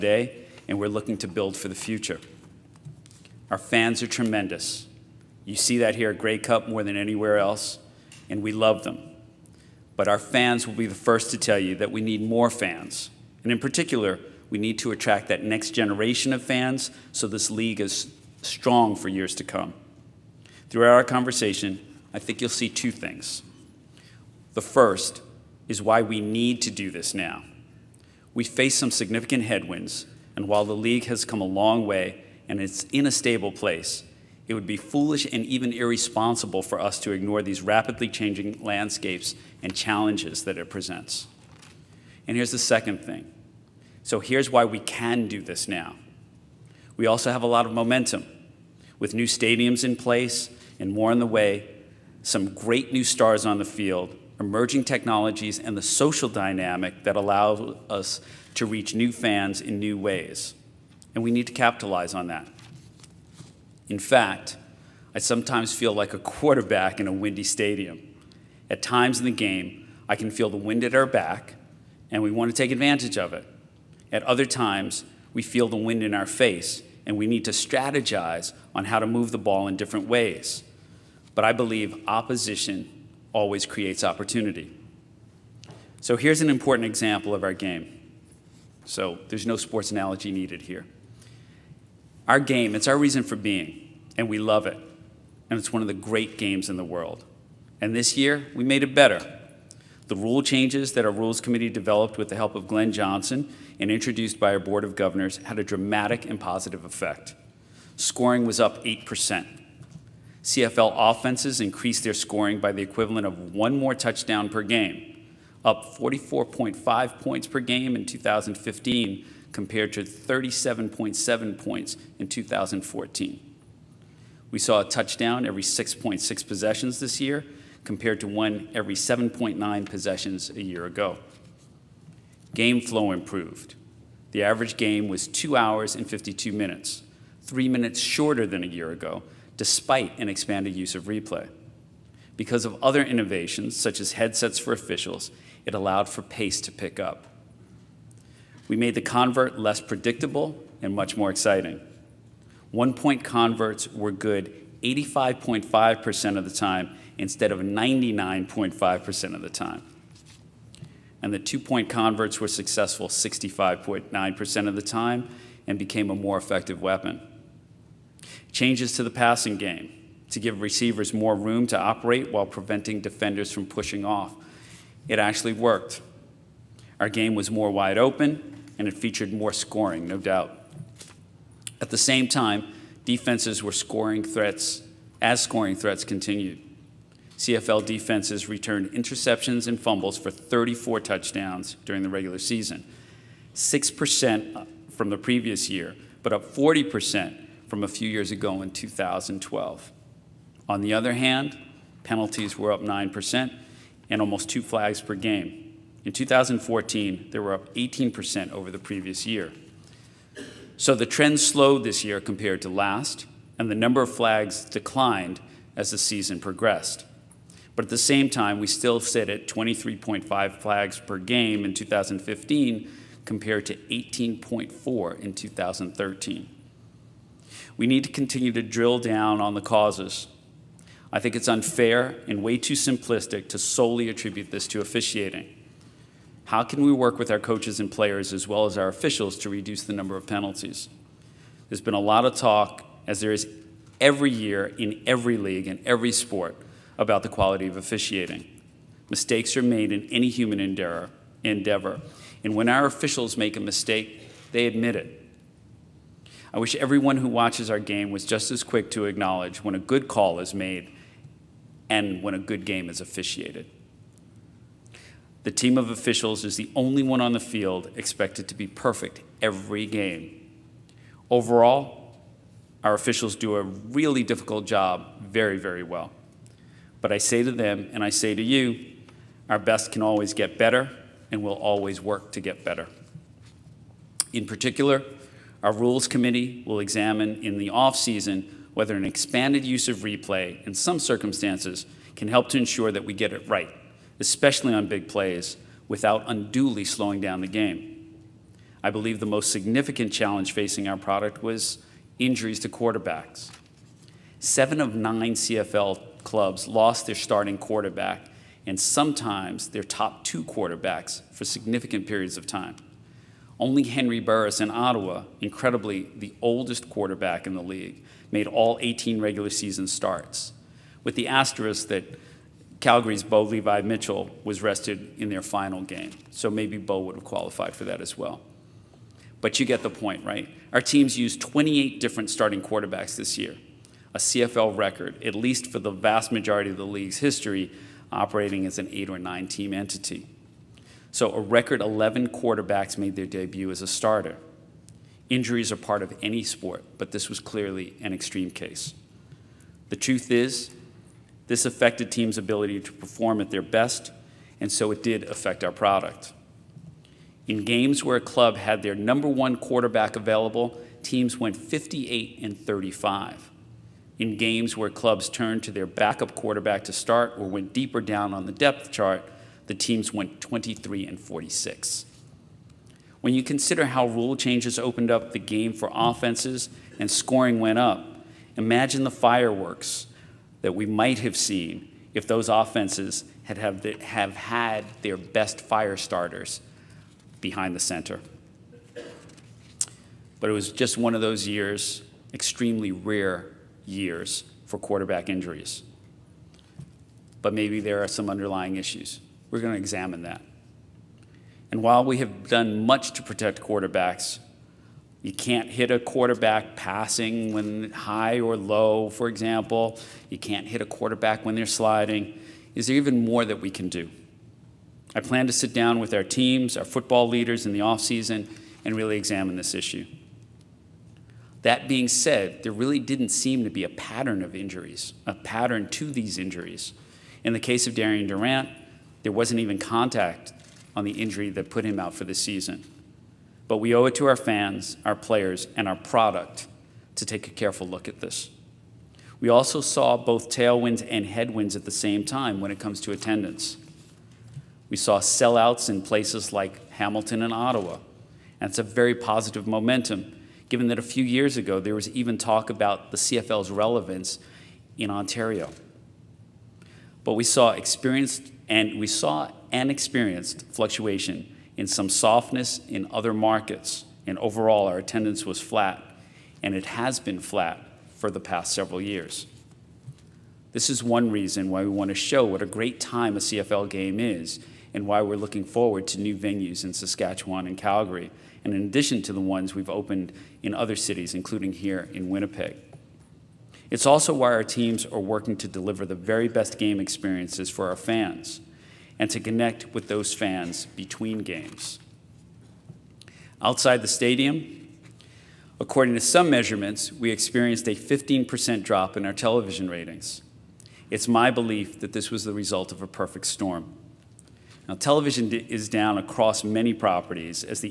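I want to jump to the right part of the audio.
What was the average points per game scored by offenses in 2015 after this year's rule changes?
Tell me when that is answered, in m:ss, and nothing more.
1:55.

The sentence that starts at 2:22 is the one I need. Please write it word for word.
Because of other innovations, such as headsets for officials, it allowed for pace to pick up.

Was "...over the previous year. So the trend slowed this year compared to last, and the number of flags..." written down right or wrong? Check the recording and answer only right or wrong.
right.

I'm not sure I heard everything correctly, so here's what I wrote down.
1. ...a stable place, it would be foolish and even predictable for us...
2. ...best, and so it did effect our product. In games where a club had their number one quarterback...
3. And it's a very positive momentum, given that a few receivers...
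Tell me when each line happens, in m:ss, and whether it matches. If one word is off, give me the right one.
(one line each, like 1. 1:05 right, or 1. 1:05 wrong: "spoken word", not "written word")
1. 0:33 wrong: "irresponsible", not "predictable"
2. 5:53 wrong: "affect", not "effect"
3. 7:28 wrong: "years", not "receivers".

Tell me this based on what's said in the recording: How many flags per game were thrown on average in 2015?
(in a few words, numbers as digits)
23.5.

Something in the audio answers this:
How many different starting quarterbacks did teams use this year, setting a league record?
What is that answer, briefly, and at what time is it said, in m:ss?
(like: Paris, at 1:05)
28, at 5:31.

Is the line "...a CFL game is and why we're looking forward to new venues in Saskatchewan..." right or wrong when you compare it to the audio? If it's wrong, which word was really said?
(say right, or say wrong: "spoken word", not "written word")
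right.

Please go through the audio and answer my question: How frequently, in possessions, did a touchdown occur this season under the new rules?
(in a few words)
every 6.6 possessions.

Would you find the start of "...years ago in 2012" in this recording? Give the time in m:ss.
3:18.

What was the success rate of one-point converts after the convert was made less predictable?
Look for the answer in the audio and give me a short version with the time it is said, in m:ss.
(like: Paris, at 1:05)
85.5%, at 2:34.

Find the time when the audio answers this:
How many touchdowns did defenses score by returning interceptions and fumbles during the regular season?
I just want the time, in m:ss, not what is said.
3:10.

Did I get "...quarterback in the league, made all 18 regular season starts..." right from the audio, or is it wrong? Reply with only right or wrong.
right.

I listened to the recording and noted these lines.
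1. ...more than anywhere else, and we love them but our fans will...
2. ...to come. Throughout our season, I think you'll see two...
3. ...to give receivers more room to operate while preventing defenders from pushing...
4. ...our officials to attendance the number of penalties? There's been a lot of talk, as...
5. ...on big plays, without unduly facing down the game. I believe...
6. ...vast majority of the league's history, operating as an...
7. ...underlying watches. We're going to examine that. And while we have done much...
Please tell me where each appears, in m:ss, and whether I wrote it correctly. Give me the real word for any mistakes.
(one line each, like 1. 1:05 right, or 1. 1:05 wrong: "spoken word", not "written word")
1. 0:06 right
2. 0:19 wrong: "conversation", not "season"
3. 2:50 right
4. 3:58 wrong: "reduce", not "attendance"
5. 4:54 wrong: "slowing", not "facing"
6. 5:35 right
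7. 6:38 wrong: "issues", not "watches".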